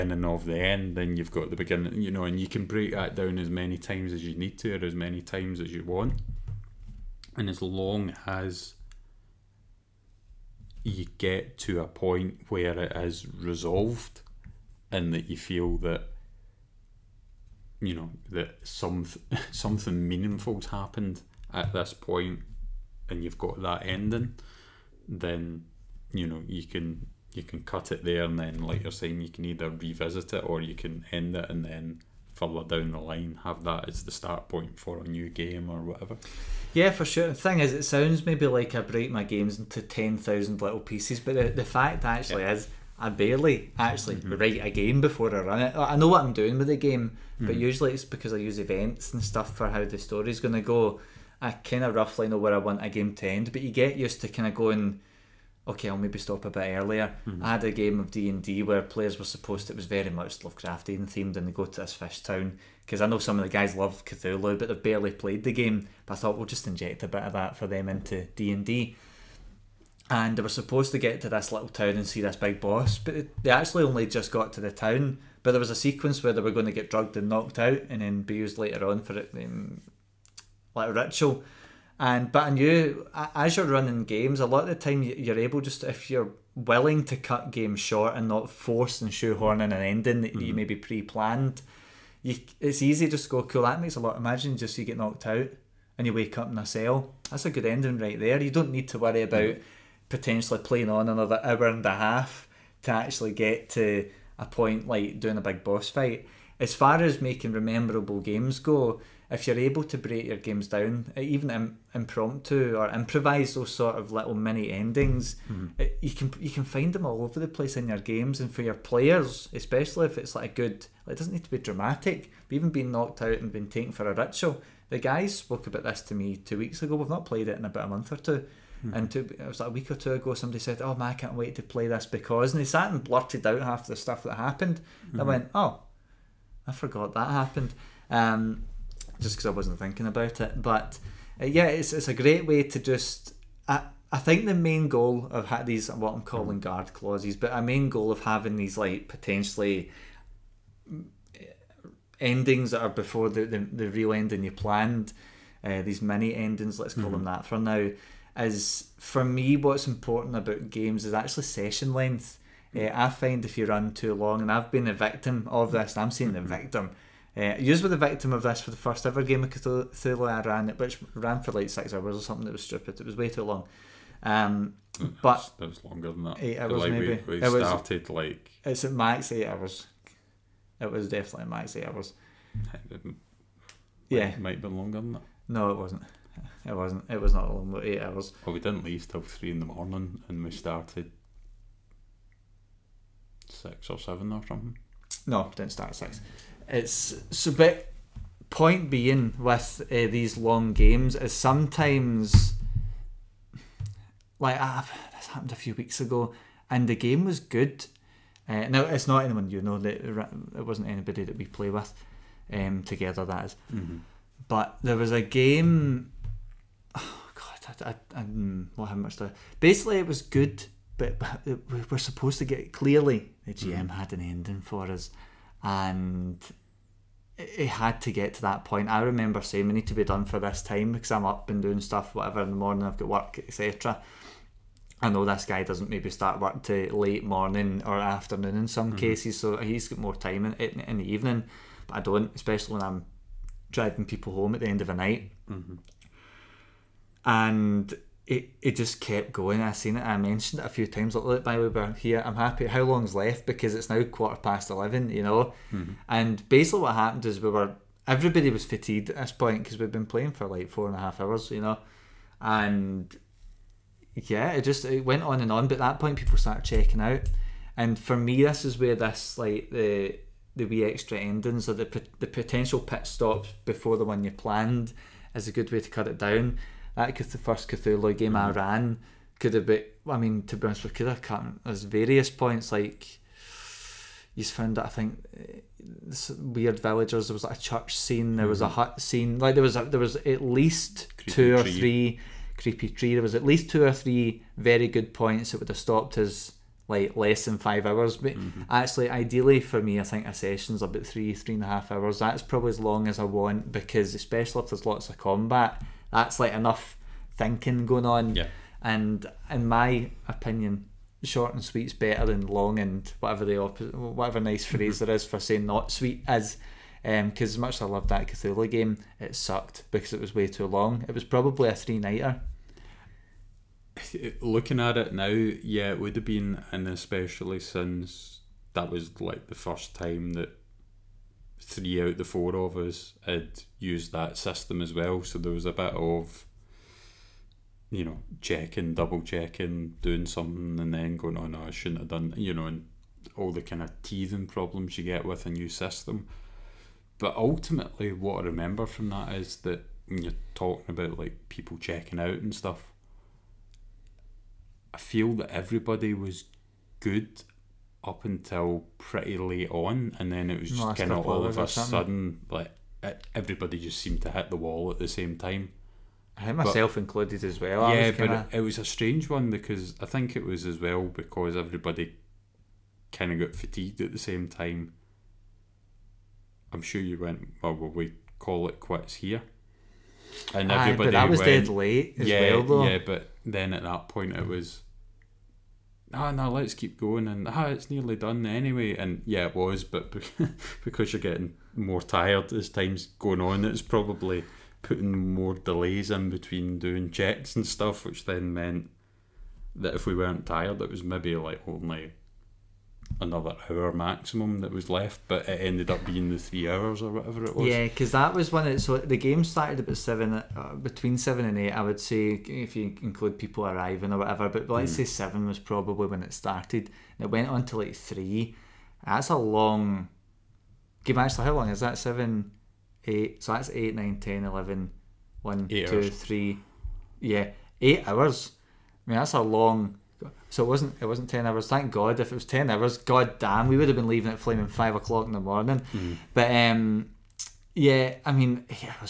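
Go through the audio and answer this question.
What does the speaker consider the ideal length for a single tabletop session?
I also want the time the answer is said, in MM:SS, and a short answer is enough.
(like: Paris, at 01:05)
3 to 3.5 hours, at 05:01.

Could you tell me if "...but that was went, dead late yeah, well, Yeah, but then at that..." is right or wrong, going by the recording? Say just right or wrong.
right.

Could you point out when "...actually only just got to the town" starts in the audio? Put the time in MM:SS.
01:13.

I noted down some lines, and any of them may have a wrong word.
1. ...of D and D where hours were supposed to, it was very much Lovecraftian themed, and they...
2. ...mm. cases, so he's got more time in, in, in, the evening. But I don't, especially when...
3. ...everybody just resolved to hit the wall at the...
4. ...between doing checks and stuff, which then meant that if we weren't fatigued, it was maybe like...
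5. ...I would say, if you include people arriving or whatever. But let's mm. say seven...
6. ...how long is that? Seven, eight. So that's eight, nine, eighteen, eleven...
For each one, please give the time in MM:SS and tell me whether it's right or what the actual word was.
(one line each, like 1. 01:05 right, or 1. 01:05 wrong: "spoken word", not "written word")
1. 00:58 wrong: "players", not "hours"
2. 03:58 right
3. 06:03 wrong: "seemed", not "resolved"
4. 06:36 wrong: "tired", not "fatigued"
5. 06:51 right
6. 07:01 wrong: "ten", not "eighteen".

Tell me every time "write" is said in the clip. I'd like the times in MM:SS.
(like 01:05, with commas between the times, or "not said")
00:44.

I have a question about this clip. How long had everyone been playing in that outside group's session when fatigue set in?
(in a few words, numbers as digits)
4.5 hours.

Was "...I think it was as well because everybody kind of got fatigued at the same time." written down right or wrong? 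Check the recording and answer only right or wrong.
right.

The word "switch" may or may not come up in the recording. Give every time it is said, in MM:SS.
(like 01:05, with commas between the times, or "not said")
not said.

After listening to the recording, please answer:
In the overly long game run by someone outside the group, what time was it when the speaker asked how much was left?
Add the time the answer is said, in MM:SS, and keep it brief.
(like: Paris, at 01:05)
quarter past eleven, at 04:14.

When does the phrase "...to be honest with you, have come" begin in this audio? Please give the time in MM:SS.
04:40.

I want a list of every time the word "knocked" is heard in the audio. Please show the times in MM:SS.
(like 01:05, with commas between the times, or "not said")
01:17, 01:34, 02:02.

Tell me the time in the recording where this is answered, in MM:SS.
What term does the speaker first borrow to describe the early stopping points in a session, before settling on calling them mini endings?
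02:26.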